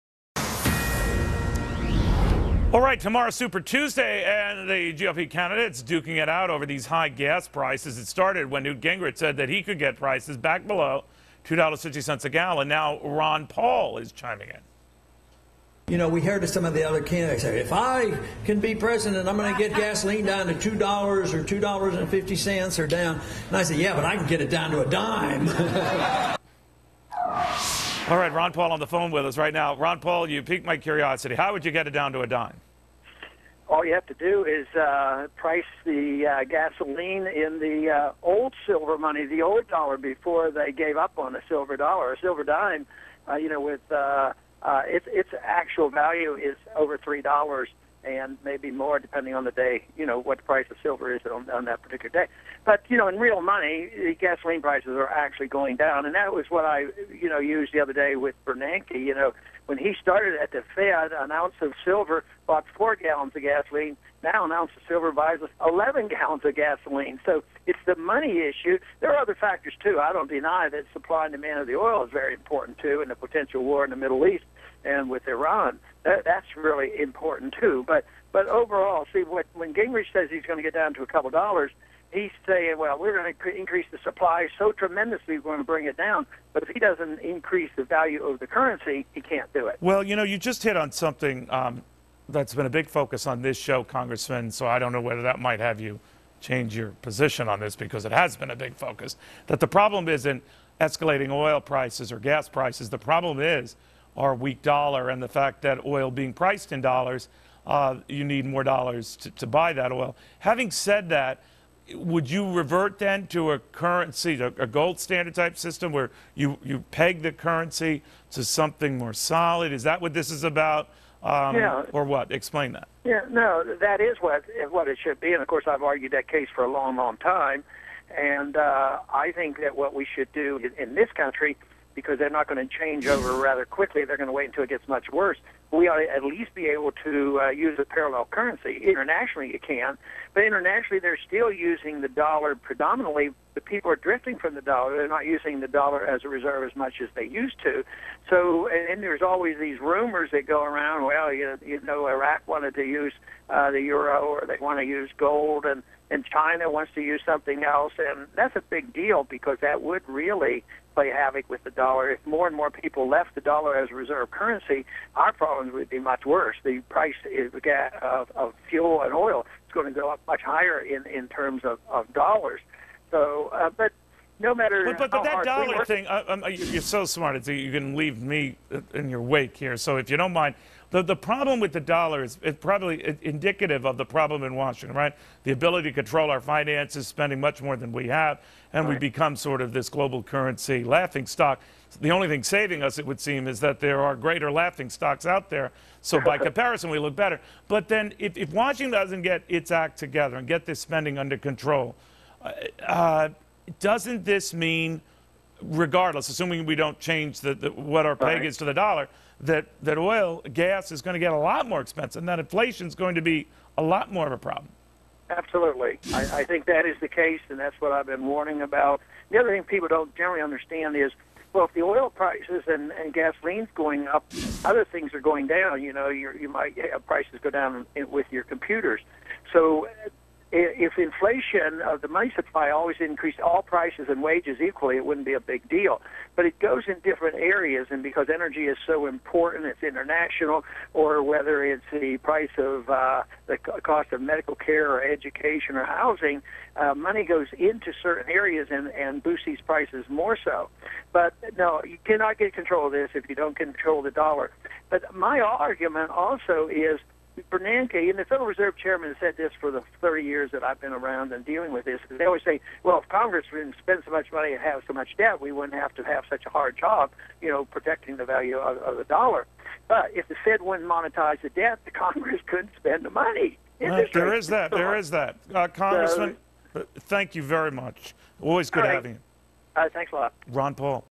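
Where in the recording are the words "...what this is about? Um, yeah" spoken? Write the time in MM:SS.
02:00.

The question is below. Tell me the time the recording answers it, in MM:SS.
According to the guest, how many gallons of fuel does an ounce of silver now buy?
01:05.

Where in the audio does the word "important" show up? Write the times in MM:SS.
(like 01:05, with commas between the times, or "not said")
01:12, 01:16, 03:59.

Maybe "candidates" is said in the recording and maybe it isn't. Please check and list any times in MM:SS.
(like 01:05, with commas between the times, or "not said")
00:05, 00:17.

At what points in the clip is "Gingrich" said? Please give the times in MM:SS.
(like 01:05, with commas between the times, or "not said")
00:08, 01:19.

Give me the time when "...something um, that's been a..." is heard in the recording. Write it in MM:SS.
01:30.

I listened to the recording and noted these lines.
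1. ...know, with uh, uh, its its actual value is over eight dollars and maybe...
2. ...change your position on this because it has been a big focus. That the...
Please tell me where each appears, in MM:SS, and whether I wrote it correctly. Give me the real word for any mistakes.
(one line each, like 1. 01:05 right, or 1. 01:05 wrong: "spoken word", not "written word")
1. 00:43 wrong: "three", not "eight"
2. 01:36 right.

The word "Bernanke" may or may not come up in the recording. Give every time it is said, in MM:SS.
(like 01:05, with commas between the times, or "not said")
00:58, 04:17.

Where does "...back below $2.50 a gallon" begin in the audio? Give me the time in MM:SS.
00:10.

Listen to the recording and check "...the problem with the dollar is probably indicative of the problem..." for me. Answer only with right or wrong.
right.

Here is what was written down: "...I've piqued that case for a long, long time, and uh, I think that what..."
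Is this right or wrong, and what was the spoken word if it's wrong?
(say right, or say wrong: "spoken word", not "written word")
wrong: "argued", not "piqued".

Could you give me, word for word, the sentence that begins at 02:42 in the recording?
If more and more people left the dollar as a reserve currency, our problem would be much worse.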